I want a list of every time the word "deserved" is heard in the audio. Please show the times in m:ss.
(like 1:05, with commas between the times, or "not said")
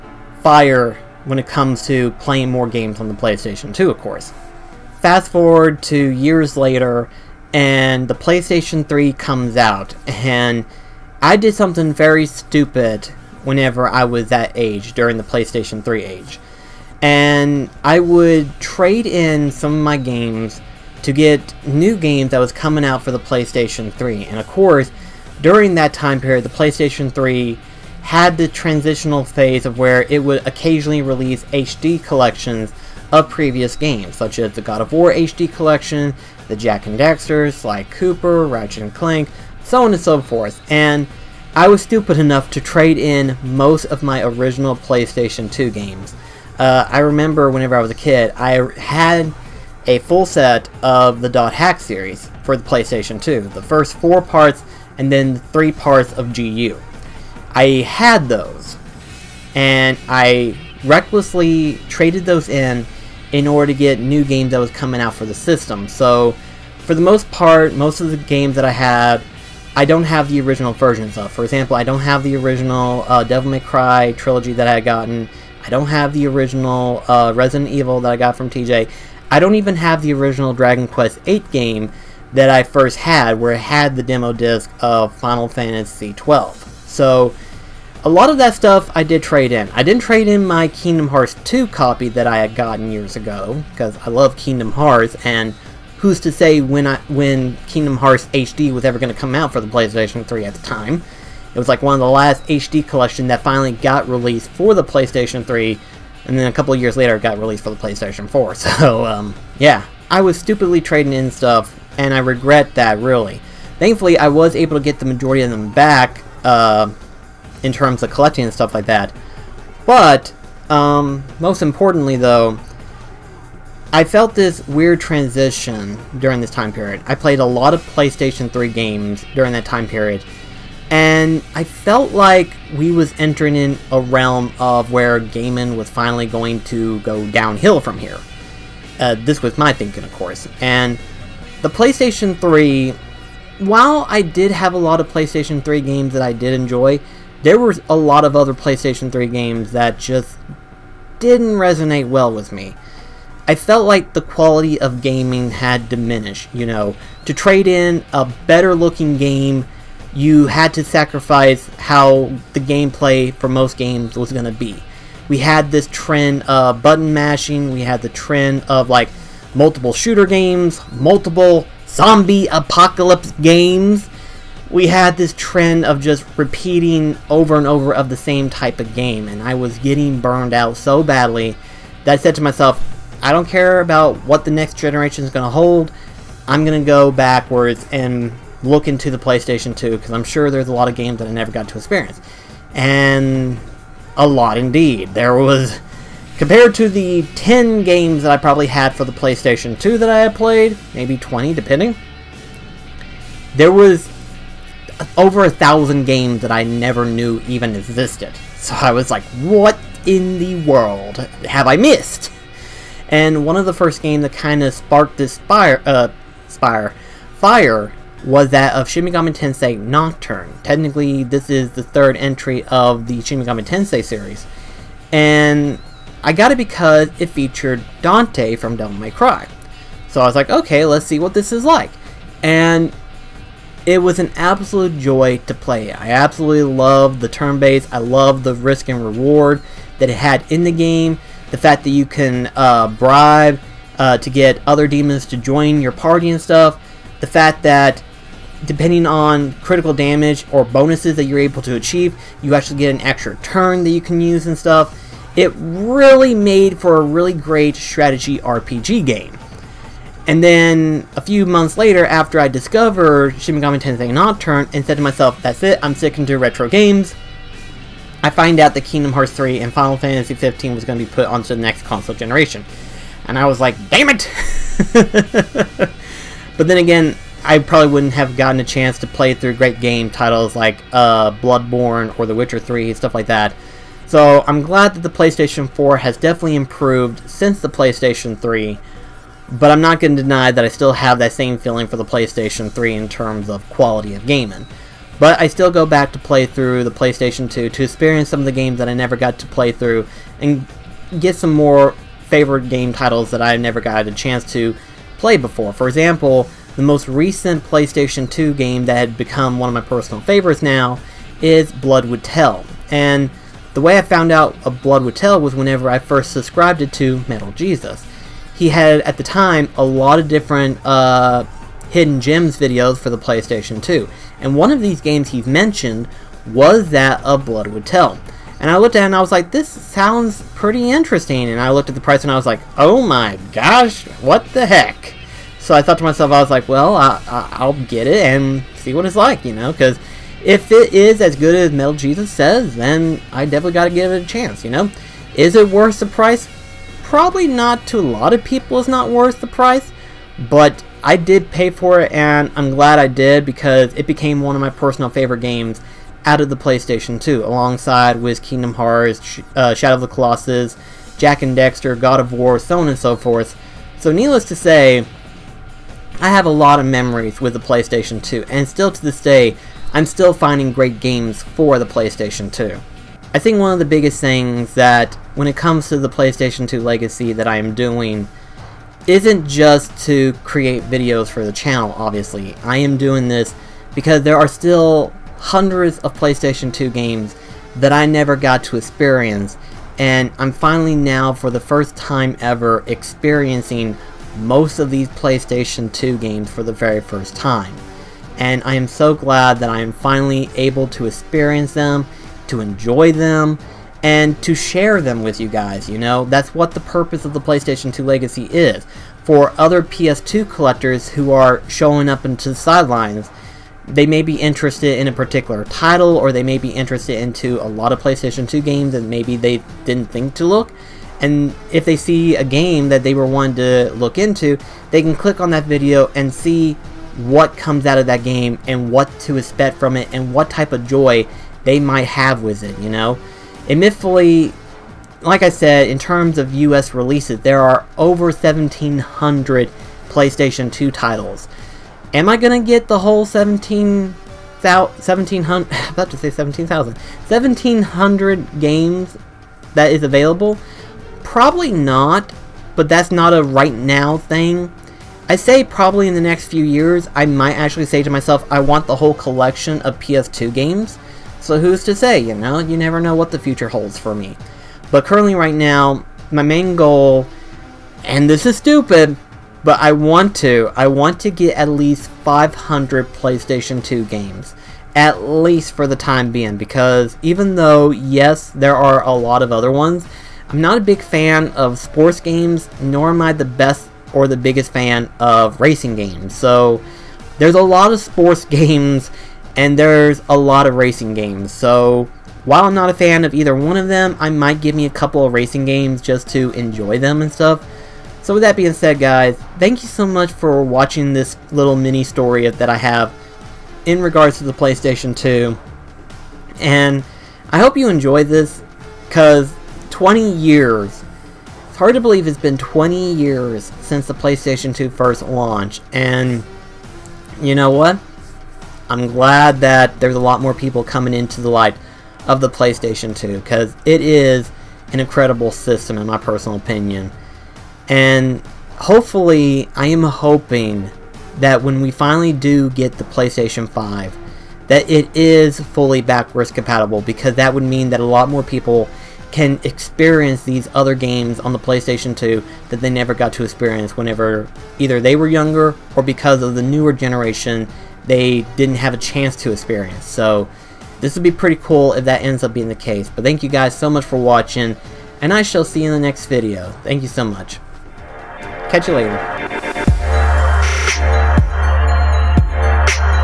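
not said.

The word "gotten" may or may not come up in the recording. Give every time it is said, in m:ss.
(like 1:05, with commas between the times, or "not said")
1:14, 1:32, 4:38.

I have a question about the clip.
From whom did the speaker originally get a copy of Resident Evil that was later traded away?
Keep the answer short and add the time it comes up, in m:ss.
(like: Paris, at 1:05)
TJ, at 1:18.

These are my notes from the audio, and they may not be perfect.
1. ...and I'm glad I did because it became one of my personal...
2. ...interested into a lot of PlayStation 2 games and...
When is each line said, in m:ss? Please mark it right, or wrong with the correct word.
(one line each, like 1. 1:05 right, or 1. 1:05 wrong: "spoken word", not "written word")
1. 5:52 right
2. 6:56 right.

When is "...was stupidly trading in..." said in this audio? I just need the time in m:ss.
1:50.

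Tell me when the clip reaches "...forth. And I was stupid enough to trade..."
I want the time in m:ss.
0:40.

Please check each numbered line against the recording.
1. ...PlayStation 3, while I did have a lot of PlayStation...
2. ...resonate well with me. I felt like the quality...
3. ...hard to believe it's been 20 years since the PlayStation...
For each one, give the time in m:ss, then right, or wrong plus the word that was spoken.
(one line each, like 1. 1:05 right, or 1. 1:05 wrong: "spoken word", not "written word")
1. 2:21 right
2. 2:31 right
3. 8:31 right.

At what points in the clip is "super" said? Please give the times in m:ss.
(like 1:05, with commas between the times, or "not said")
not said.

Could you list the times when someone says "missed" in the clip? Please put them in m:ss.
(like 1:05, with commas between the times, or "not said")
3:31.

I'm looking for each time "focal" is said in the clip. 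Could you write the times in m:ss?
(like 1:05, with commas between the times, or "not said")
not said.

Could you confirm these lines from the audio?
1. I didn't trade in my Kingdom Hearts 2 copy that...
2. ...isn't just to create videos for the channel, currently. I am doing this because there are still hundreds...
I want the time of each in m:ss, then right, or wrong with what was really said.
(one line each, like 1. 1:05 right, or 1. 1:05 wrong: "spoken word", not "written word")
1. 1:29 right
2. 6:19 wrong: "obviously", not "currently".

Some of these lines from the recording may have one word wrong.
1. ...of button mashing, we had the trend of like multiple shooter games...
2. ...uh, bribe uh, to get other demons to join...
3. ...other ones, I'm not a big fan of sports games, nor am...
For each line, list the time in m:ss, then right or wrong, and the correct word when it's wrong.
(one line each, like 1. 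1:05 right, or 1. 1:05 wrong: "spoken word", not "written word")
1. 2:46 right
2. 4:02 right
3. 7:59 right.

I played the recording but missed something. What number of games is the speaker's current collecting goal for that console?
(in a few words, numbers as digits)
500.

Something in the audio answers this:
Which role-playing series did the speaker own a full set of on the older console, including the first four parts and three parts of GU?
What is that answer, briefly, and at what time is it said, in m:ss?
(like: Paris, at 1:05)
Dot Hack, at 0:51.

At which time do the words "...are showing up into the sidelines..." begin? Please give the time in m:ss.
6:51.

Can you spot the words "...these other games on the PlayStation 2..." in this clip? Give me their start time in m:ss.
9:00.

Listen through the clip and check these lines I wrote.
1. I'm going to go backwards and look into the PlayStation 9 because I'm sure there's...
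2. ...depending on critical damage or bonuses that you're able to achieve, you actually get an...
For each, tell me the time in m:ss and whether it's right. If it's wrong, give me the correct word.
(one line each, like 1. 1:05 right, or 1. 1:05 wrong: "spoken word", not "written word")
1. 3:06 wrong: "2", not "9"
2. 4:08 right.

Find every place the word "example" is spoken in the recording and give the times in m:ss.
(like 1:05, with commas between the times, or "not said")
1:11, 5:05.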